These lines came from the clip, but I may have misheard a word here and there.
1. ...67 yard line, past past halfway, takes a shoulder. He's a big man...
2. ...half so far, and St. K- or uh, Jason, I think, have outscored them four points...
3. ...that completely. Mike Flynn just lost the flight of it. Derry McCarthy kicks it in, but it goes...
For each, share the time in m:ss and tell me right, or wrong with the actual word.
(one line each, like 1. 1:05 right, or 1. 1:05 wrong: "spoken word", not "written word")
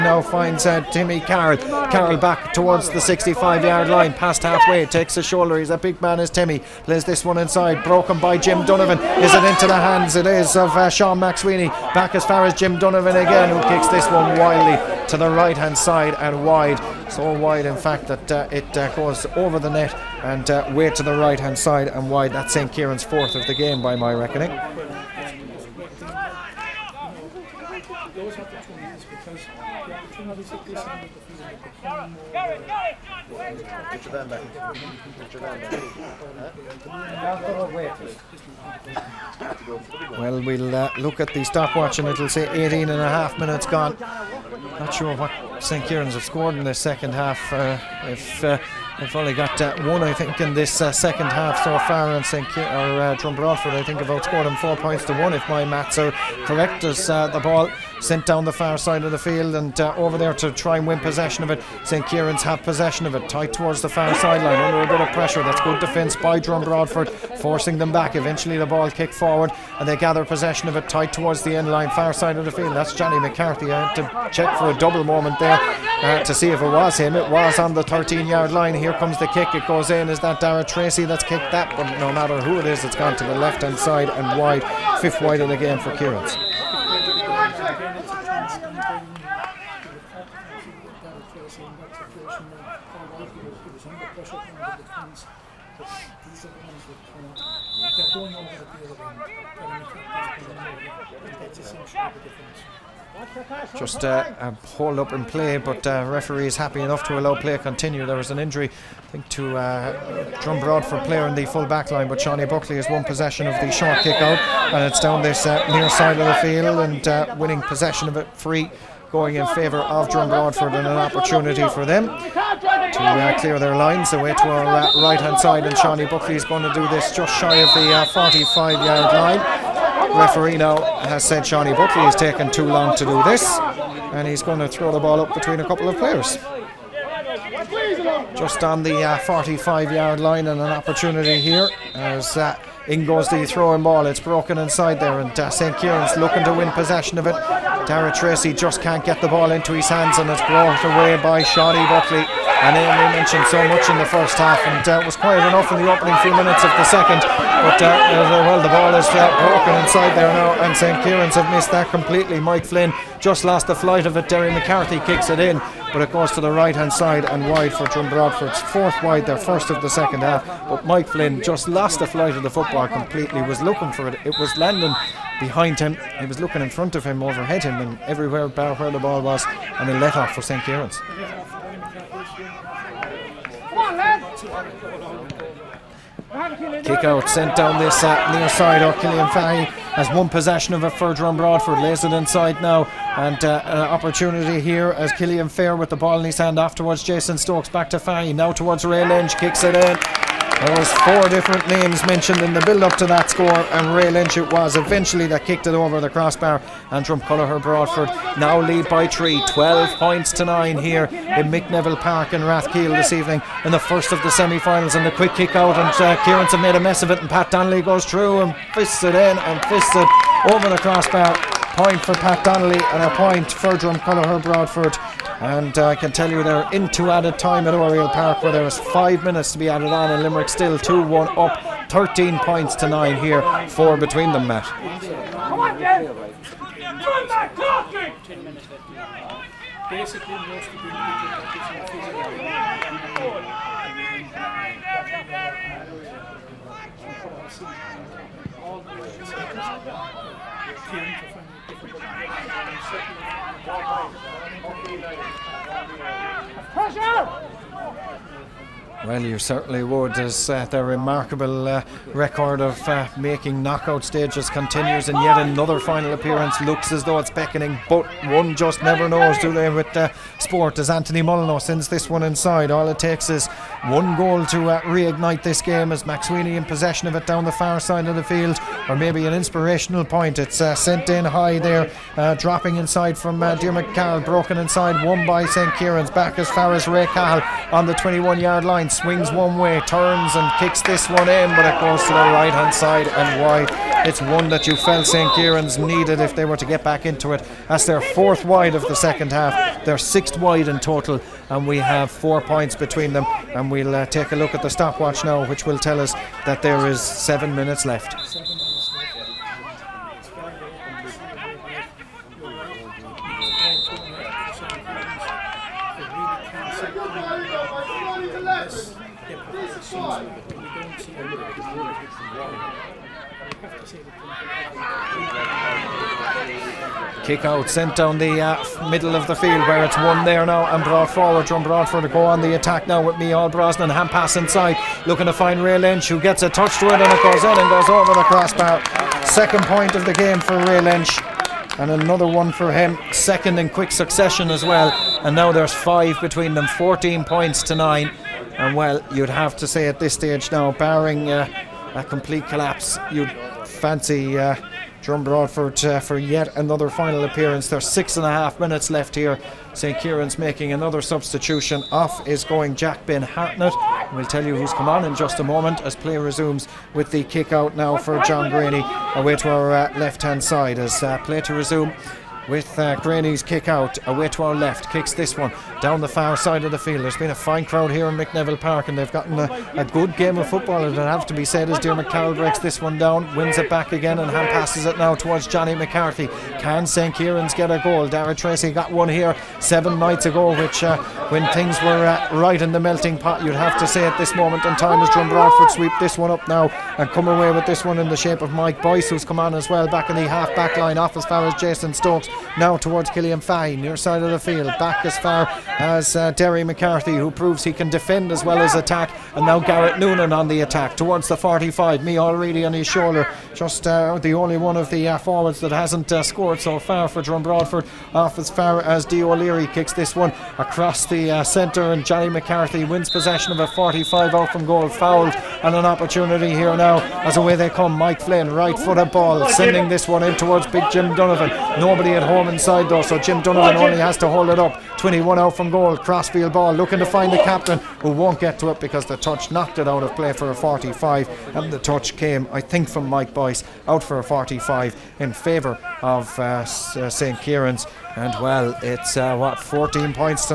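1. 0:02 wrong: "65", not "67"
2. 0:51 wrong: "Broadford", not "Jason"
3. 2:41 right.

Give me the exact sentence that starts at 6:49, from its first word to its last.
And now Garrett Noonan on the attack towards the 45.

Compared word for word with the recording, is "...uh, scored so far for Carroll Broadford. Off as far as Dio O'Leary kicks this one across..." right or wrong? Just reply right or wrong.
wrong.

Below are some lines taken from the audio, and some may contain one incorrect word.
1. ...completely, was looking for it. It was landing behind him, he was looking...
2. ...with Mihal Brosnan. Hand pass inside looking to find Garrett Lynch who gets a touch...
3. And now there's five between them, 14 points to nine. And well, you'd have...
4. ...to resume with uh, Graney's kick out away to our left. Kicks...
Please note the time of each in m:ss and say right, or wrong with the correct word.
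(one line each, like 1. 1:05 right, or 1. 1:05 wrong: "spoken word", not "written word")
1. 2:52 right
2. 5:32 wrong: "Ray", not "Garrett"
3. 5:45 right
4. 6:11 right.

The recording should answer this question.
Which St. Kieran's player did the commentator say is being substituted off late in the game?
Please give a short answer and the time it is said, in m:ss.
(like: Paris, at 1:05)
Jack Ben Hartnett, at 6:02.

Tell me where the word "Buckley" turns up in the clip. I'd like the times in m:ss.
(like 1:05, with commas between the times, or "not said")
1:52, 2:06, 2:11, 2:31.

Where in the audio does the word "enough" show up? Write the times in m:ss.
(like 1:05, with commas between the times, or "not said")
1:46, 2:35.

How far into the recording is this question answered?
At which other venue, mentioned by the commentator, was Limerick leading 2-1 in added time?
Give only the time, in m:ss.
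3:47.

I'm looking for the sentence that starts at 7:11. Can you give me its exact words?
Nobody at home inside though, so Jim Donovan oh, only has to hold it up.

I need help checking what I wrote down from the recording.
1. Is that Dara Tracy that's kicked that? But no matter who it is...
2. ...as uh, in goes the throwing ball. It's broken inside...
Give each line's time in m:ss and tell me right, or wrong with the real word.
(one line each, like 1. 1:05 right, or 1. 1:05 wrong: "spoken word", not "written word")
1. 1:20 right
2. 2:21 right.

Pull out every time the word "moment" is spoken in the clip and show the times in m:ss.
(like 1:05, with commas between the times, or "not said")
1:15, 6:05, 6:34.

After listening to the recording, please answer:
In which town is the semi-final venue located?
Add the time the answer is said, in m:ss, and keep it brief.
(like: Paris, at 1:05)
Rathkeale, at 3:32.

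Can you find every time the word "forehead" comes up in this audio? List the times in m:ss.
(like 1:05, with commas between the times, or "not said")
not said.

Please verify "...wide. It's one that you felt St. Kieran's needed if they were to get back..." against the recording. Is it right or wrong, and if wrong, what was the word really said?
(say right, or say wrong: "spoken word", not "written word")
right.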